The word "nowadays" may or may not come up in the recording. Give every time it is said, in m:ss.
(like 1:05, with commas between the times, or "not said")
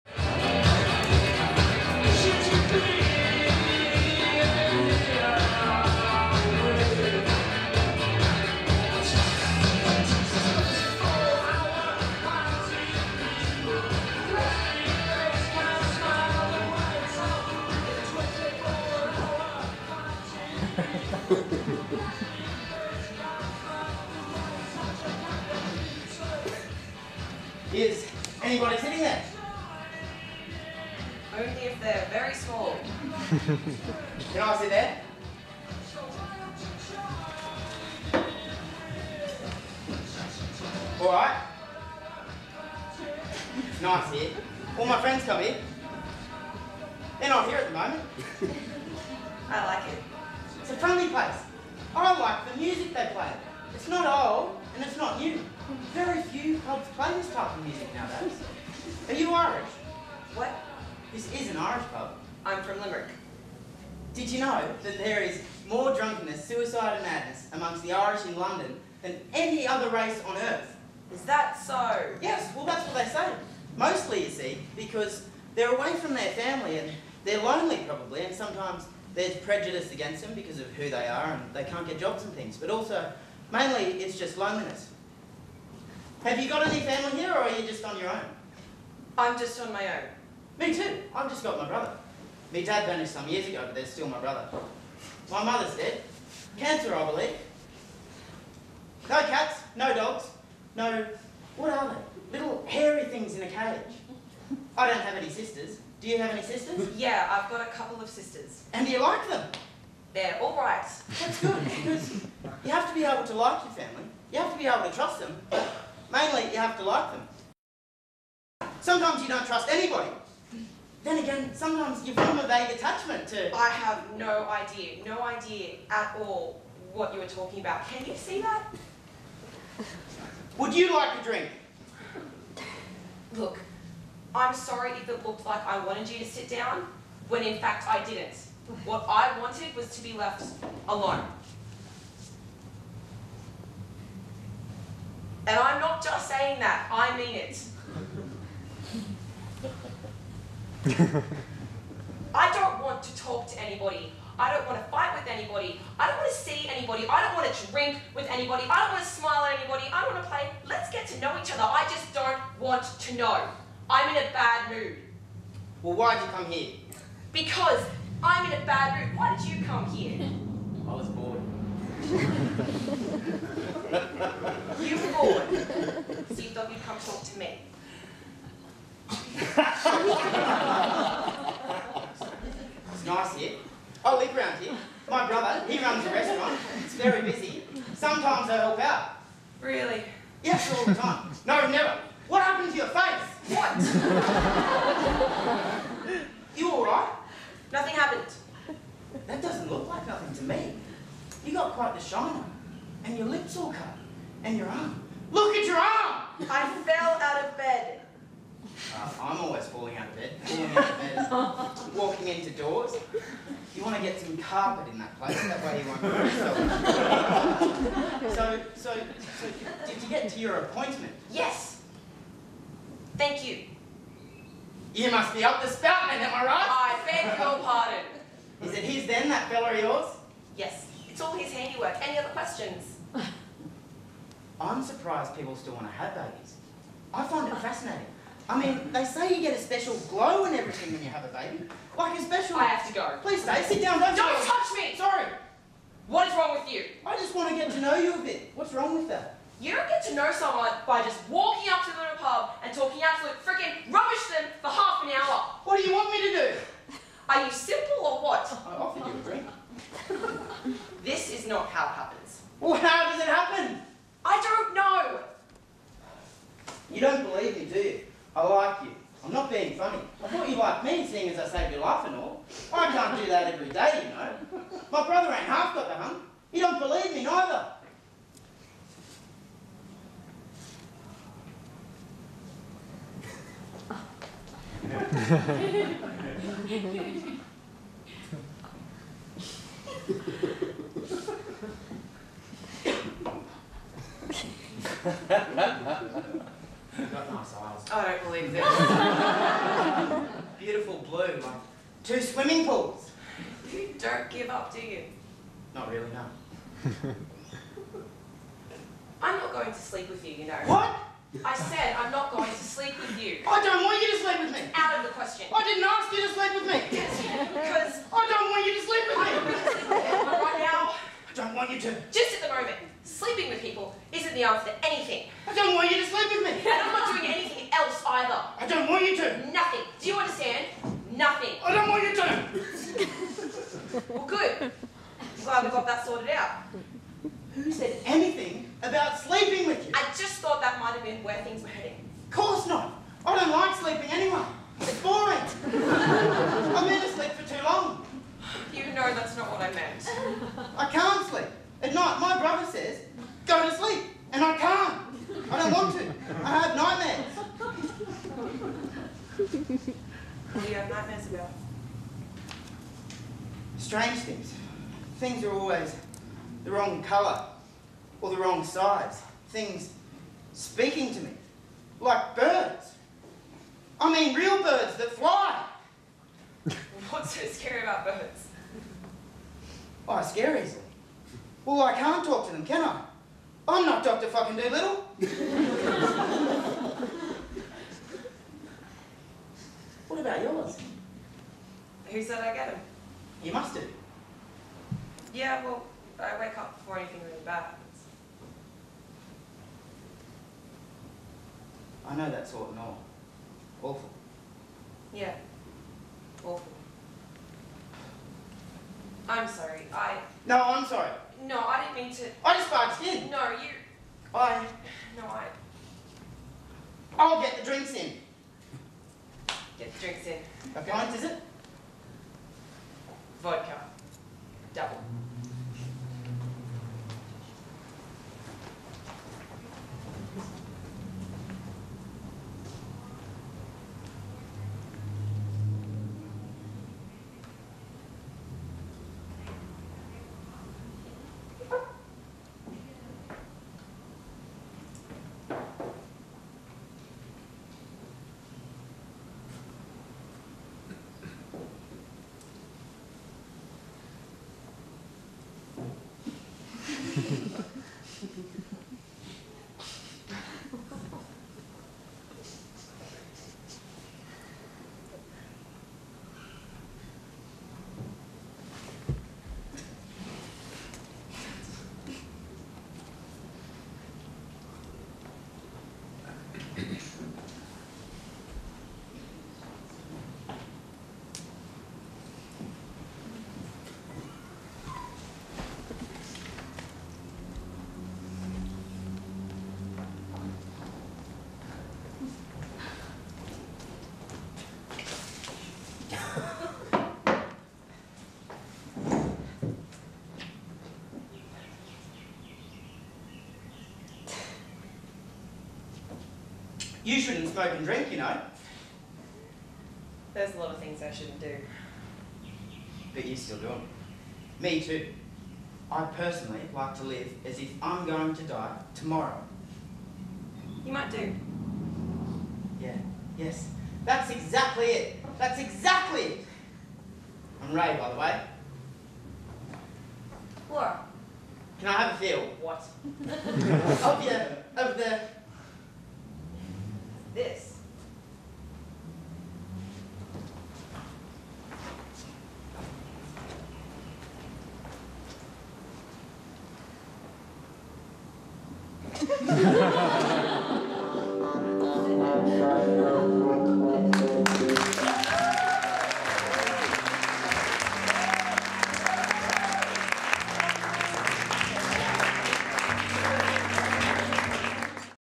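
0:57.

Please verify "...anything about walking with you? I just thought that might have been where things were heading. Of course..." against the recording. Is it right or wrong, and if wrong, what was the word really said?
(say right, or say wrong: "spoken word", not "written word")
wrong: "sleeping", not "walking".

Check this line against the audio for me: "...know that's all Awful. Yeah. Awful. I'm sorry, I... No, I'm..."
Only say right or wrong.
right.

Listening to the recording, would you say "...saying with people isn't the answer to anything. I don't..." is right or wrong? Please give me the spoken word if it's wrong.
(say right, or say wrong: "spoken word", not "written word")
wrong: "sleeping", not "saying".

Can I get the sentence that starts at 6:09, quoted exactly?
Things speaking to me, like birds.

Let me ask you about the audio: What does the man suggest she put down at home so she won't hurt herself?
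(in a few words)
Carpet.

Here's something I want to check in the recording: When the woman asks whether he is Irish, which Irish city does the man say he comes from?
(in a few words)
Limerick.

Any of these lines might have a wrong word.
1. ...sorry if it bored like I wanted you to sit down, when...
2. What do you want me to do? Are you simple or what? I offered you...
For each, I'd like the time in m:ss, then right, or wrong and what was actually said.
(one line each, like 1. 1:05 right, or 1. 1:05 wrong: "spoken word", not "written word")
1. 2:14 wrong: "looked", not "bored"
2. 4:15 right.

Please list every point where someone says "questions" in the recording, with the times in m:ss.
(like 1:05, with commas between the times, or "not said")
3:52, 5:15.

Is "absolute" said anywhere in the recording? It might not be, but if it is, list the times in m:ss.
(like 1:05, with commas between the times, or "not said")
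4:13.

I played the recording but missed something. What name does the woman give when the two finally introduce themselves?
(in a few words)
Laura.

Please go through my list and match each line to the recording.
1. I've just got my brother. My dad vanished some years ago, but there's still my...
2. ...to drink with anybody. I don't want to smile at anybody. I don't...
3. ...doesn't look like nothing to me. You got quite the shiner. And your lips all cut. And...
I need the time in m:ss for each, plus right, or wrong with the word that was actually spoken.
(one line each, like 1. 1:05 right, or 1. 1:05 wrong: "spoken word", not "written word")
1. 1:31 right
2. 2:37 right
3. 3:19 right.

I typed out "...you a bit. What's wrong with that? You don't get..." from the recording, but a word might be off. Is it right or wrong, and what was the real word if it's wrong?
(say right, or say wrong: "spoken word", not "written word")
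right.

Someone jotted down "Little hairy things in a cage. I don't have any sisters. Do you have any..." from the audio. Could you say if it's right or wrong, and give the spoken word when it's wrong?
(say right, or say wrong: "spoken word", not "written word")
right.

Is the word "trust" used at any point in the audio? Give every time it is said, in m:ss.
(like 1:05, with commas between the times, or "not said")
1:54, 1:59.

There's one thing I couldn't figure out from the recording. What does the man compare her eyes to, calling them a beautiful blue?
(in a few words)
Two swimming pools.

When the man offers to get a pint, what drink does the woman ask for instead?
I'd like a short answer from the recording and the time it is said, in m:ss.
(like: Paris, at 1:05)
Vodka, at 7:03.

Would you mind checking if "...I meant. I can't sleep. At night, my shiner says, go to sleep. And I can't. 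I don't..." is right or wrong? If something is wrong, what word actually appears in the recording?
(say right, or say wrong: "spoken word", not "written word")
wrong: "brother", not "shiner".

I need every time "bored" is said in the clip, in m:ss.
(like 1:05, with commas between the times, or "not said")
2:51, 2:55.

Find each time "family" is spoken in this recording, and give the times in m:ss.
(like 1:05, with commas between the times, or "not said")
1:16, 1:26, 1:53.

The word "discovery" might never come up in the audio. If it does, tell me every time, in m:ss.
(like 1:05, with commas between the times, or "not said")
not said.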